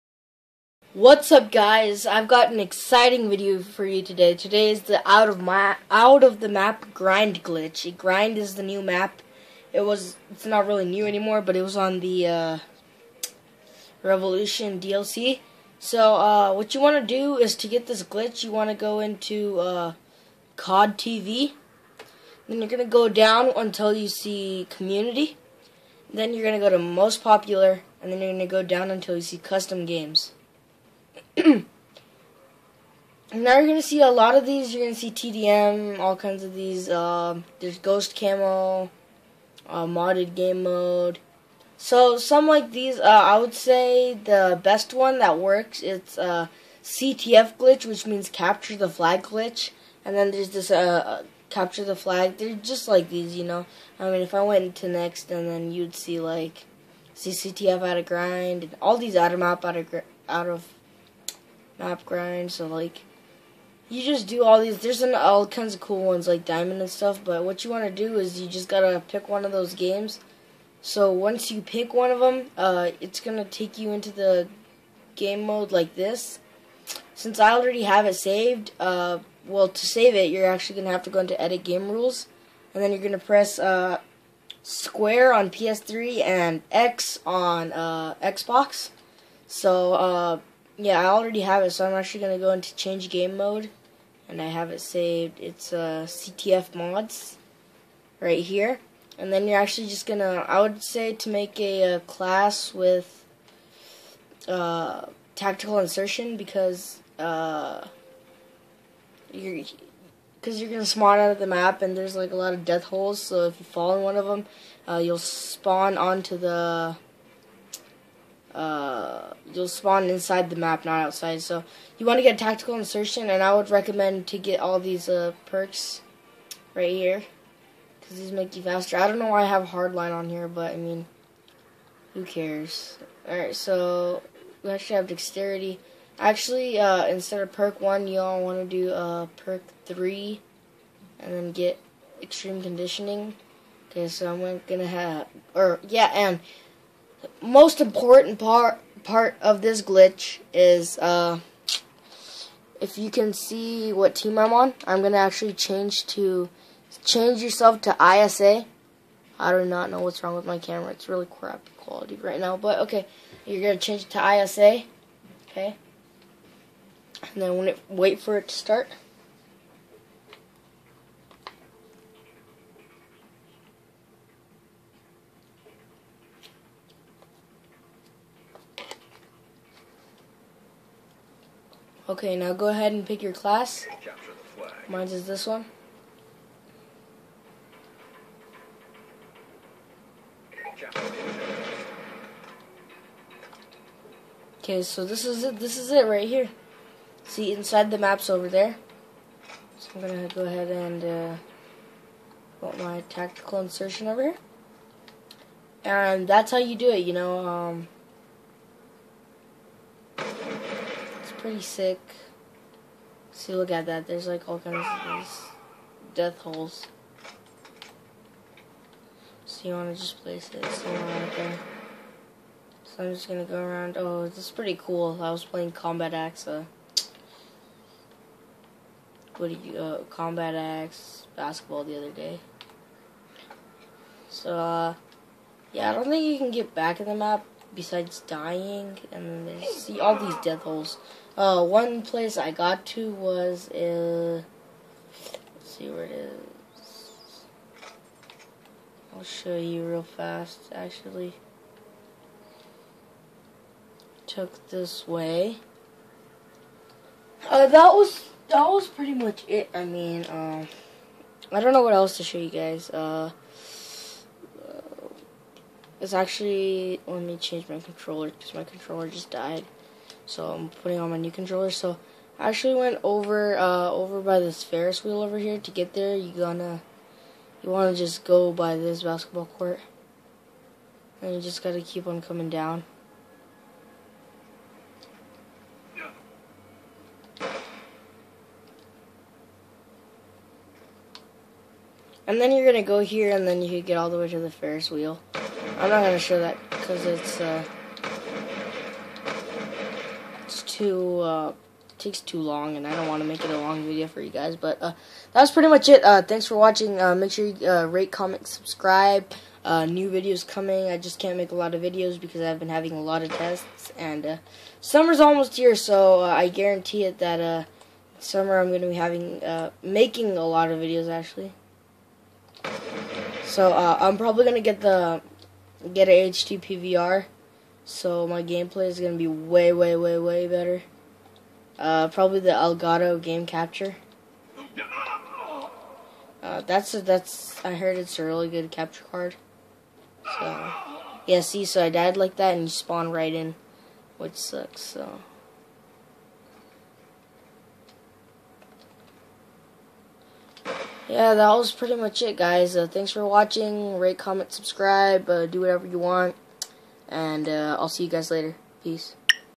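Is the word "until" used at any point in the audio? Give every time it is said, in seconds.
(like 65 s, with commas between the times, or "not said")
23 s, 28 s.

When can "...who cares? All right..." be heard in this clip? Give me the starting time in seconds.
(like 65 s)
132 s.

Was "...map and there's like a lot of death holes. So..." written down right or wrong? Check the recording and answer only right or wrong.
right.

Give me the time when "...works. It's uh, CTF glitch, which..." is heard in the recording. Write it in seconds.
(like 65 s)
45 s.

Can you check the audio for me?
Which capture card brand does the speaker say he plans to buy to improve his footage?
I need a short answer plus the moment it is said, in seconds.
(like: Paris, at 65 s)
Elgato, at 332 s.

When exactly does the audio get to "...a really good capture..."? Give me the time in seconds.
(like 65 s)
338 s.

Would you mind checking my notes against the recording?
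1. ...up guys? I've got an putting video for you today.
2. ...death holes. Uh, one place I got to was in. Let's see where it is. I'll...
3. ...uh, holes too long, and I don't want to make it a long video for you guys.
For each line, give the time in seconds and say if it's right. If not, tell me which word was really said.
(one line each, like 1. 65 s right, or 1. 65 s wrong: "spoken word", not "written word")
1. 1 s wrong: "exciting", not "putting"
2. 240 s right
3. 301 s wrong: "takes", not "holes".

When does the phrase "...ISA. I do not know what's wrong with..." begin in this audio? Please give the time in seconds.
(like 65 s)
158 s.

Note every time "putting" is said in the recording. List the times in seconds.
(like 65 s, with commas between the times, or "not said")
270 s.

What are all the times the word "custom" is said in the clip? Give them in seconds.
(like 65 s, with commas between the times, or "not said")
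29 s.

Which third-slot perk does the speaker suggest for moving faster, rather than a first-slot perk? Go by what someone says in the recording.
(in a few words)
Extreme conditioning.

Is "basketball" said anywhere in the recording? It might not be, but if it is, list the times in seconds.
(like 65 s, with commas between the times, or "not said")
231 s, 279 s.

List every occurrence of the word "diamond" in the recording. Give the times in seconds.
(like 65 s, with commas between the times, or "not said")
66 s.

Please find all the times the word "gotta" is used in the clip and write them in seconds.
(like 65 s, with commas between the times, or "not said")
68 s, 281 s.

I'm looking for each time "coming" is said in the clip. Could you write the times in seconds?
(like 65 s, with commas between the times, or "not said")
282 s, 310 s.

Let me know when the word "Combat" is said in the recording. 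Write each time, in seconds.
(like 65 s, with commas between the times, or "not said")
225 s, 230 s.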